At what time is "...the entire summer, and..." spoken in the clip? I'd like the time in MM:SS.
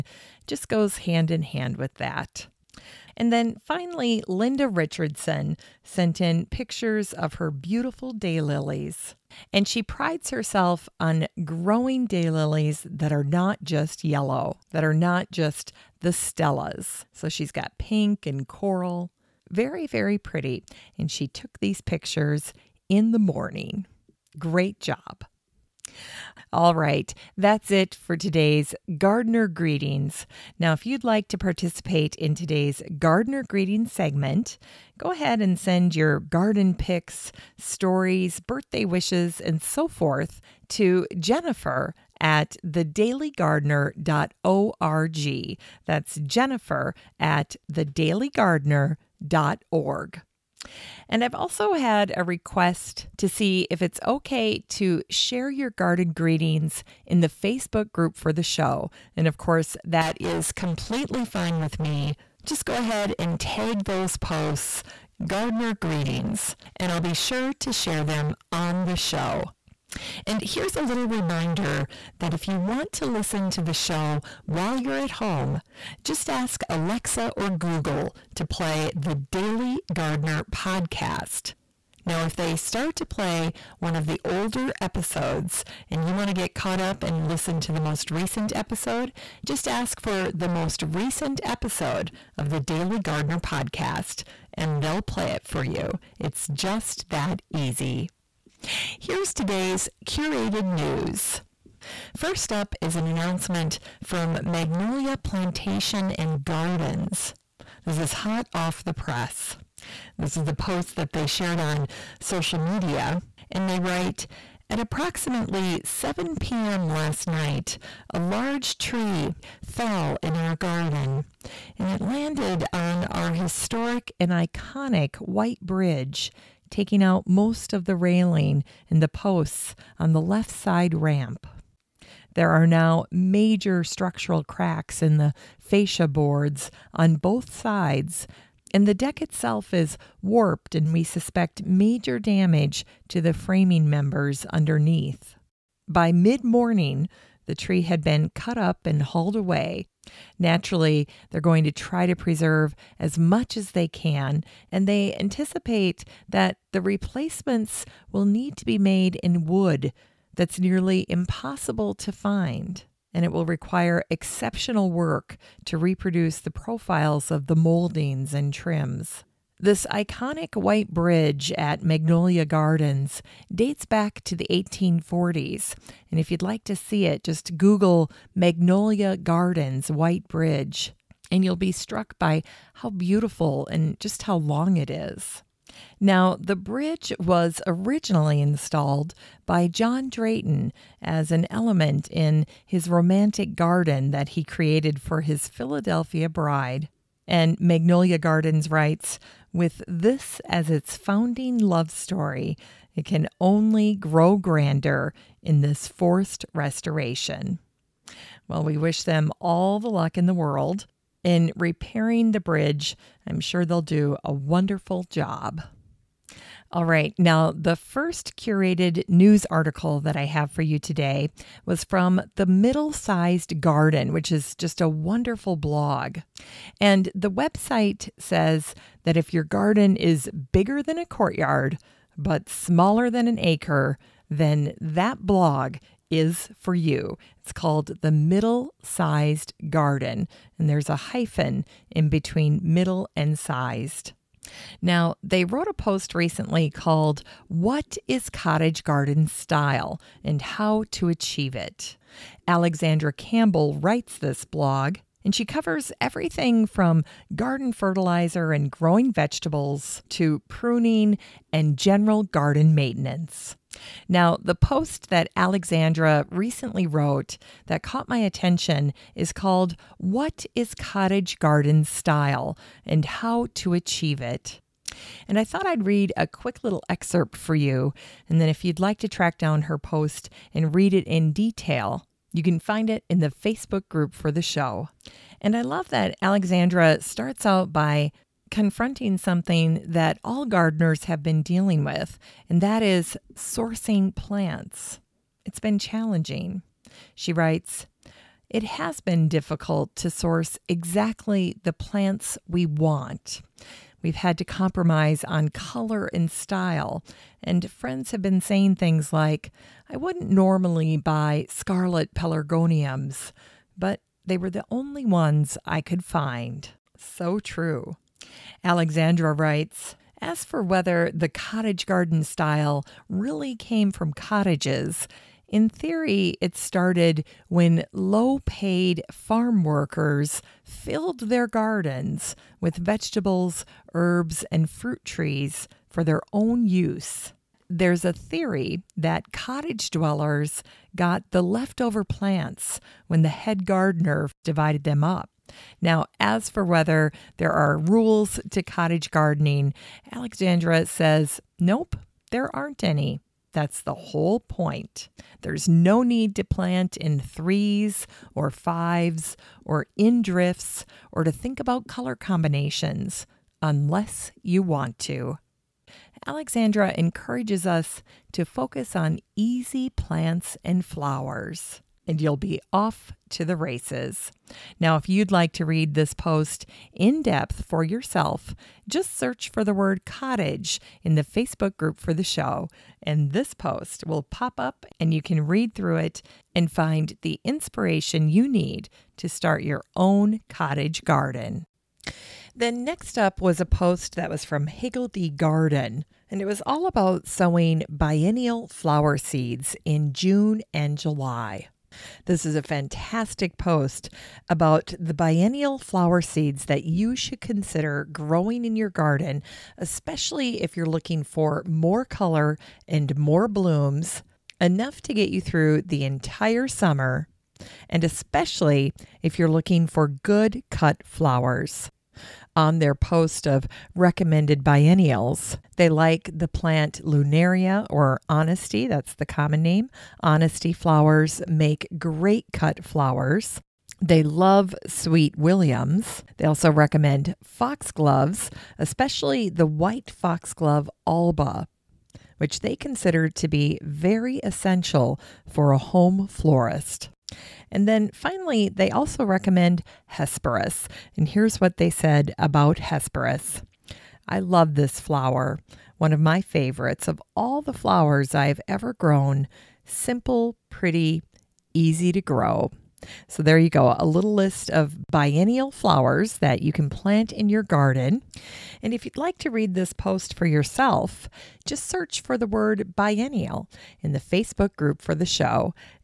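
06:55.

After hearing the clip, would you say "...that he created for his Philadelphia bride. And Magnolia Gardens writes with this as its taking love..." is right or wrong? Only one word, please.
wrong.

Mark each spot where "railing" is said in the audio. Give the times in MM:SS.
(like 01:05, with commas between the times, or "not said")
02:07.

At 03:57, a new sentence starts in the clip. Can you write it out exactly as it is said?
It's called the middle sized garden, and there's a hyphen in between middle and sized.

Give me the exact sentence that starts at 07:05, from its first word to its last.
They like the plant Lunaria or Honesty, that's the common name.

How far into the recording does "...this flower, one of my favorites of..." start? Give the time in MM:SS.
07:34.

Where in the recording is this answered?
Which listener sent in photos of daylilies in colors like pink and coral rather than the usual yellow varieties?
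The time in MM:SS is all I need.
00:04.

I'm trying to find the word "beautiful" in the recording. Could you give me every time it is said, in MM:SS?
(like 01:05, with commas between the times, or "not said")
00:07, 03:02.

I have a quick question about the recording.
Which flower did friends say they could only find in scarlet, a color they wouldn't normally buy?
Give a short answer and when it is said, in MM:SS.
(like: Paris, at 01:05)
pelargoniums, at 05:12.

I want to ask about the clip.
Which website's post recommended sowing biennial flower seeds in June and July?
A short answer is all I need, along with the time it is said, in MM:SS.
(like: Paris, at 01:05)
Higgledy Garden, at 06:34.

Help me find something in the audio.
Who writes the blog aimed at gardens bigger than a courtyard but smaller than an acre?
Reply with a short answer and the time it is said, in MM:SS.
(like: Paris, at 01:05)
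Alexandra Campbell, at 04:12.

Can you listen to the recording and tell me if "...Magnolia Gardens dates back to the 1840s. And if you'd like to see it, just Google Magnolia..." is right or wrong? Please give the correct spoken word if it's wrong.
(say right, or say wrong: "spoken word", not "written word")
right.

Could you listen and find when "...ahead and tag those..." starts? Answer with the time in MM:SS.
01:02.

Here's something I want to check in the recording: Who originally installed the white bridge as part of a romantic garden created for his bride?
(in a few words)
John Drayton.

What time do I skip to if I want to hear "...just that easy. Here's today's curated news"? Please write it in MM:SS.
01:36.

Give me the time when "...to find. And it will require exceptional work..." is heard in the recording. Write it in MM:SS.
02:41.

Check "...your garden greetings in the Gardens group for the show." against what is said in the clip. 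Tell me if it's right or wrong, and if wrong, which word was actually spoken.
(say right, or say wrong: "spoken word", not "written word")
wrong: "Facebook", not "Gardens".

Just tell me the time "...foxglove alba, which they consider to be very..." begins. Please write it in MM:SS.
07:20.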